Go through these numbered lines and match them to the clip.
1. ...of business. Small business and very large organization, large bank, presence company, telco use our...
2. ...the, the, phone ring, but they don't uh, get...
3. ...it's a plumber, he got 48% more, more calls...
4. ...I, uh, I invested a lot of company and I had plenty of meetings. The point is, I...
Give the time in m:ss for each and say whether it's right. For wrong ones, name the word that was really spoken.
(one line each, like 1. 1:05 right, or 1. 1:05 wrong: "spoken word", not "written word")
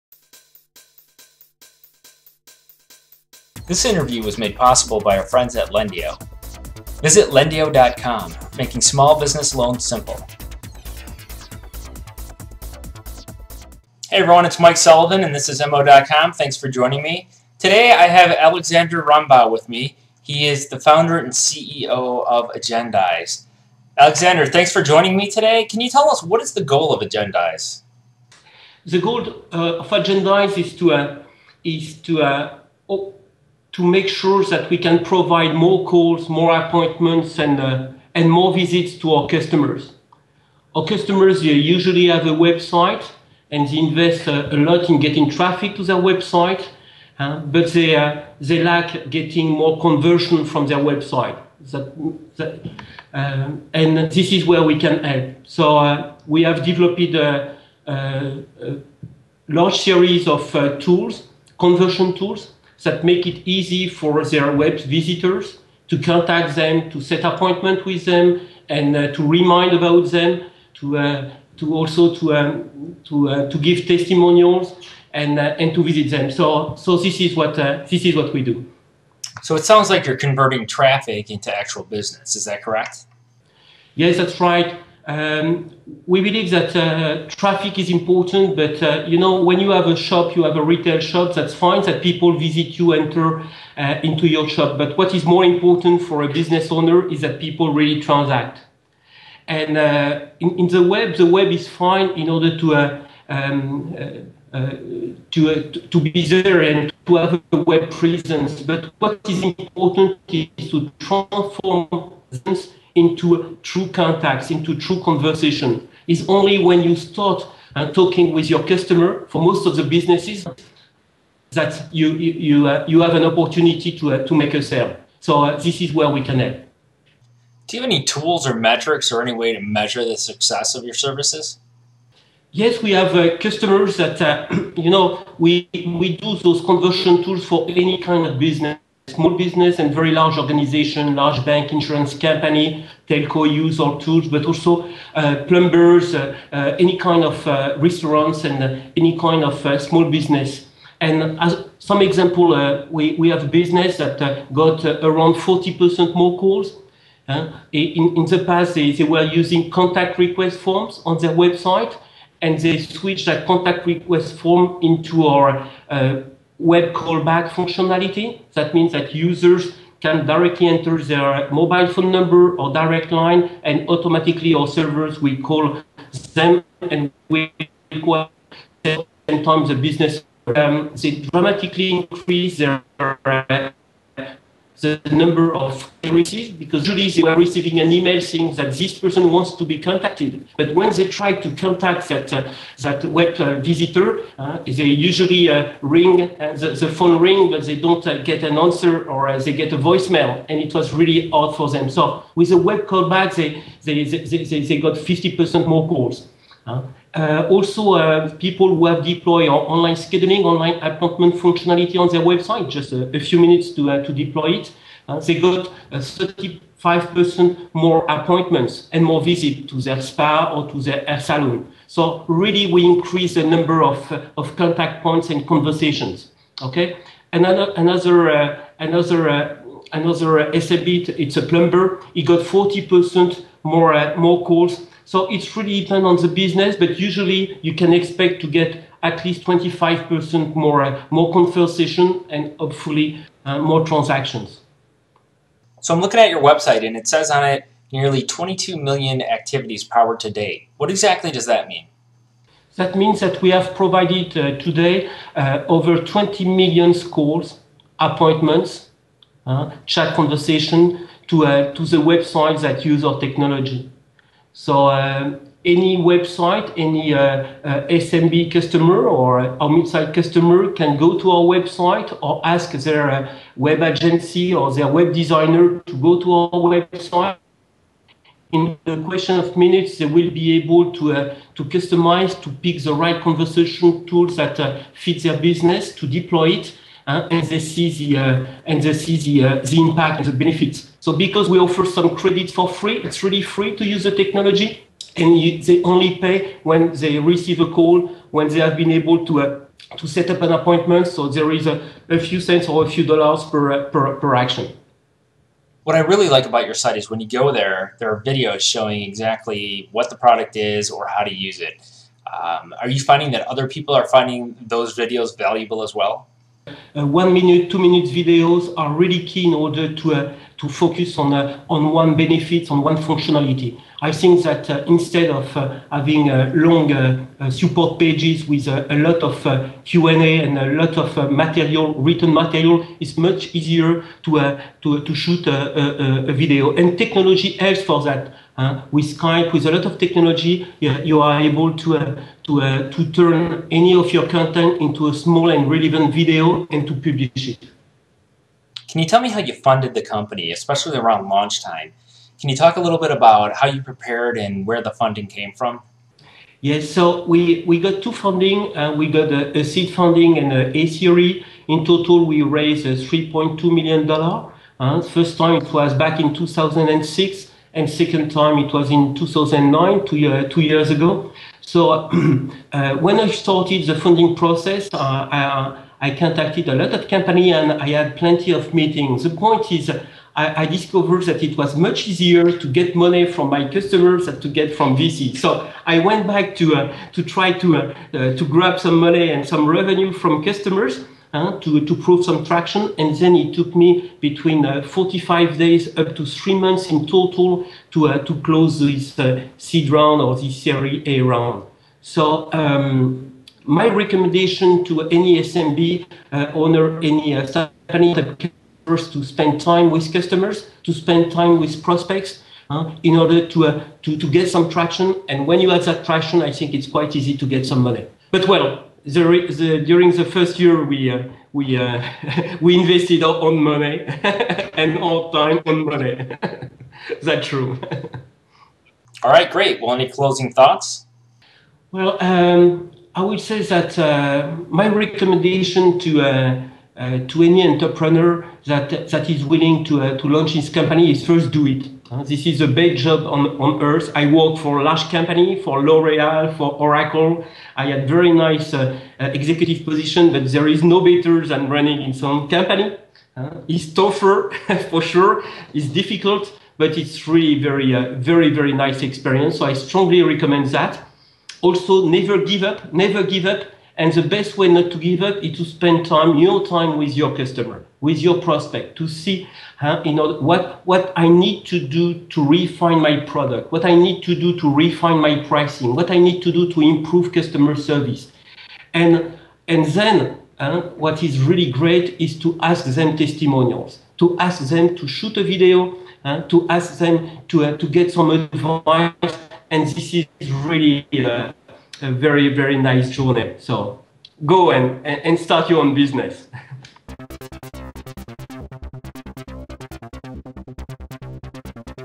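1. 2:18 wrong: "insurance", not "presence"
2. 3:16 right
3. 3:51 wrong: "40", not "48"
4. 6:14 wrong: "contacted", not "invested".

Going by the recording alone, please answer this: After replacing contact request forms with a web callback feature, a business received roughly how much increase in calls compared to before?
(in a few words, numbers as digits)
40%.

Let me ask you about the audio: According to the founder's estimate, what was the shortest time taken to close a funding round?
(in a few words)
45 days.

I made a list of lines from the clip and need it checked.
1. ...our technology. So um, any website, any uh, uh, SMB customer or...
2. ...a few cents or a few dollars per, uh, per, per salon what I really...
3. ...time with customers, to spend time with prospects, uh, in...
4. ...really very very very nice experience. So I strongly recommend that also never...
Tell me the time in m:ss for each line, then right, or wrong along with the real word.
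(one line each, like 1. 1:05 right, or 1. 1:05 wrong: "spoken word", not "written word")
1. 4:23 right
2. 5:02 wrong: "action", not "salon"
3. 6:49 right
4. 7:37 right.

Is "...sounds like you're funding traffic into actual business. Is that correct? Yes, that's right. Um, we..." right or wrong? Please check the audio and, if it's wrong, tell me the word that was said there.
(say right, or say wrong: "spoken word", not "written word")
wrong: "converting", not "funding".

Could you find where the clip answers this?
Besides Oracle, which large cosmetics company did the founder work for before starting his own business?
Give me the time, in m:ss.
7:25.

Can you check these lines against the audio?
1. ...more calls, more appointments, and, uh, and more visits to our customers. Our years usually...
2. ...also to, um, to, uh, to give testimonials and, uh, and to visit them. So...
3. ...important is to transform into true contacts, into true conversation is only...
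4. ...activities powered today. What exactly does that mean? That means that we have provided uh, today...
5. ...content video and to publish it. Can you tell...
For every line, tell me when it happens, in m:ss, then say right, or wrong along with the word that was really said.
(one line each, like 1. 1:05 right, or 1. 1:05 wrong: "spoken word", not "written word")
1. 0:35 wrong: "customers", not "years"
2. 1:11 right
3. 1:49 right
4. 4:09 right
5. 5:45 wrong: "relevant", not "content".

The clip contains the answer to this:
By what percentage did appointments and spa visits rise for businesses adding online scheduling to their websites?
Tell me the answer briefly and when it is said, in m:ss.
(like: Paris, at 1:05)
35%, at 3:35.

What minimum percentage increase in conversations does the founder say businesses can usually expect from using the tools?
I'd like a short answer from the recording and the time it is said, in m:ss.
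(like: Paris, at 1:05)
25%, at 3:59.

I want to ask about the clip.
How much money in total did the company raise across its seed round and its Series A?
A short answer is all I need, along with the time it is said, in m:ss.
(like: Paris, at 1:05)
$3.2 million, at 6:03.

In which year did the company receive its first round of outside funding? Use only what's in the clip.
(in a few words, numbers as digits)
2006.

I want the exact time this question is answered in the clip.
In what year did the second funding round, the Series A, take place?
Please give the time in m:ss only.
6:09.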